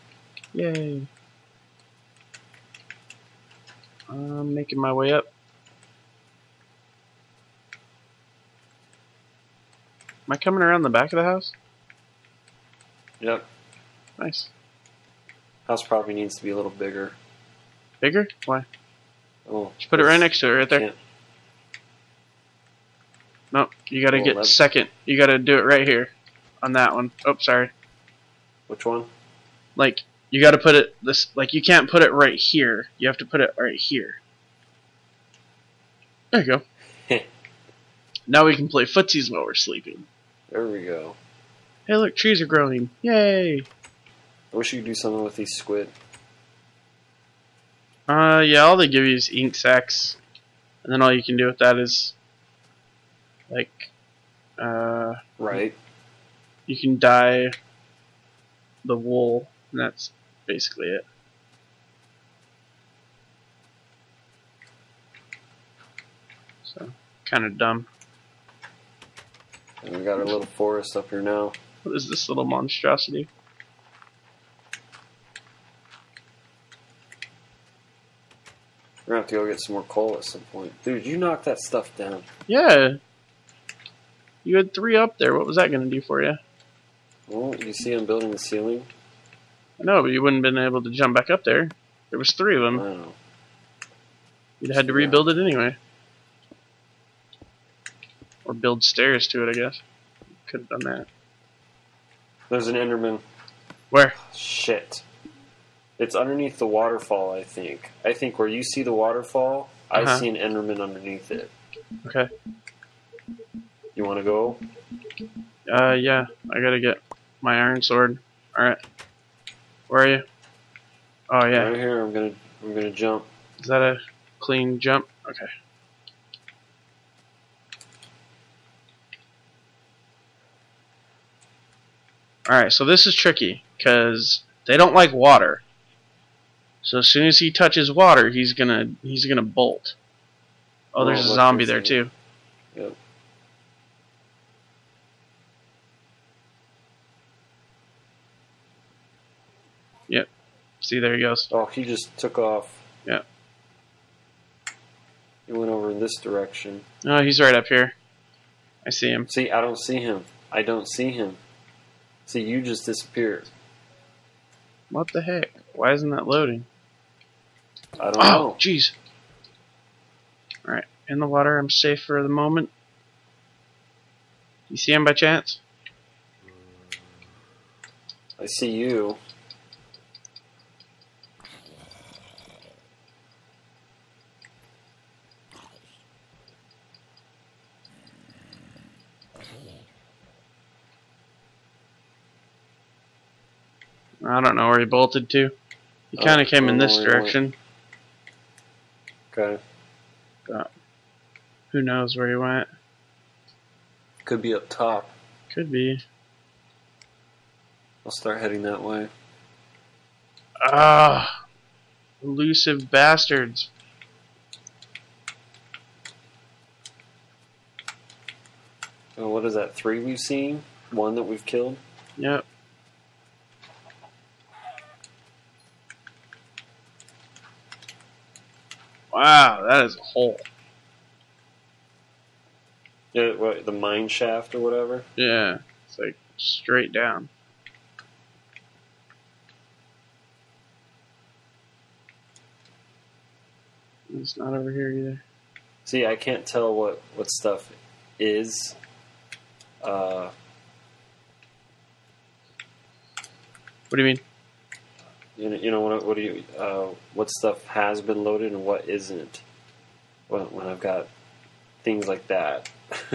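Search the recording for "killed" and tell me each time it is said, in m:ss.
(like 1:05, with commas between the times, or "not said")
3:41.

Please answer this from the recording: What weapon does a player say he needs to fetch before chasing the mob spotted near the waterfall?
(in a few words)
Iron sword.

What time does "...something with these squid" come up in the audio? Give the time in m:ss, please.
0:44.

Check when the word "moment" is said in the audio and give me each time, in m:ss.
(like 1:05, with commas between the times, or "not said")
2:52.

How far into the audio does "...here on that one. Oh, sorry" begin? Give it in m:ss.
0:25.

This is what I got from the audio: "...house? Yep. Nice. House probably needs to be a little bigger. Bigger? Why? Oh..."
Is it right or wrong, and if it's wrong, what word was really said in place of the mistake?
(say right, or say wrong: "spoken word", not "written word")
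right.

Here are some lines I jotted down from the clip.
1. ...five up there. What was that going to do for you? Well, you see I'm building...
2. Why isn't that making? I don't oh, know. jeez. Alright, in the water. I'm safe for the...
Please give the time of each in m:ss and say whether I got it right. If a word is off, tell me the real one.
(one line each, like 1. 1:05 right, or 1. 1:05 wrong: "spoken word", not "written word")
1. 1:24 wrong: "three", not "five"
2. 2:45 wrong: "loading", not "making".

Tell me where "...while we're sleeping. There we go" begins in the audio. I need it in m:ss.
0:39.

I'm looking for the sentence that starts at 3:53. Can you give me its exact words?
Yeah, what, the mine shaft or whatever?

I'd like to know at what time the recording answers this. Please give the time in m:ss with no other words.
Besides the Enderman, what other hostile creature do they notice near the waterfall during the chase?
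2:21.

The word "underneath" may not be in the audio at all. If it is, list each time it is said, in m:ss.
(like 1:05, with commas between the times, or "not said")
1:46, 1:50.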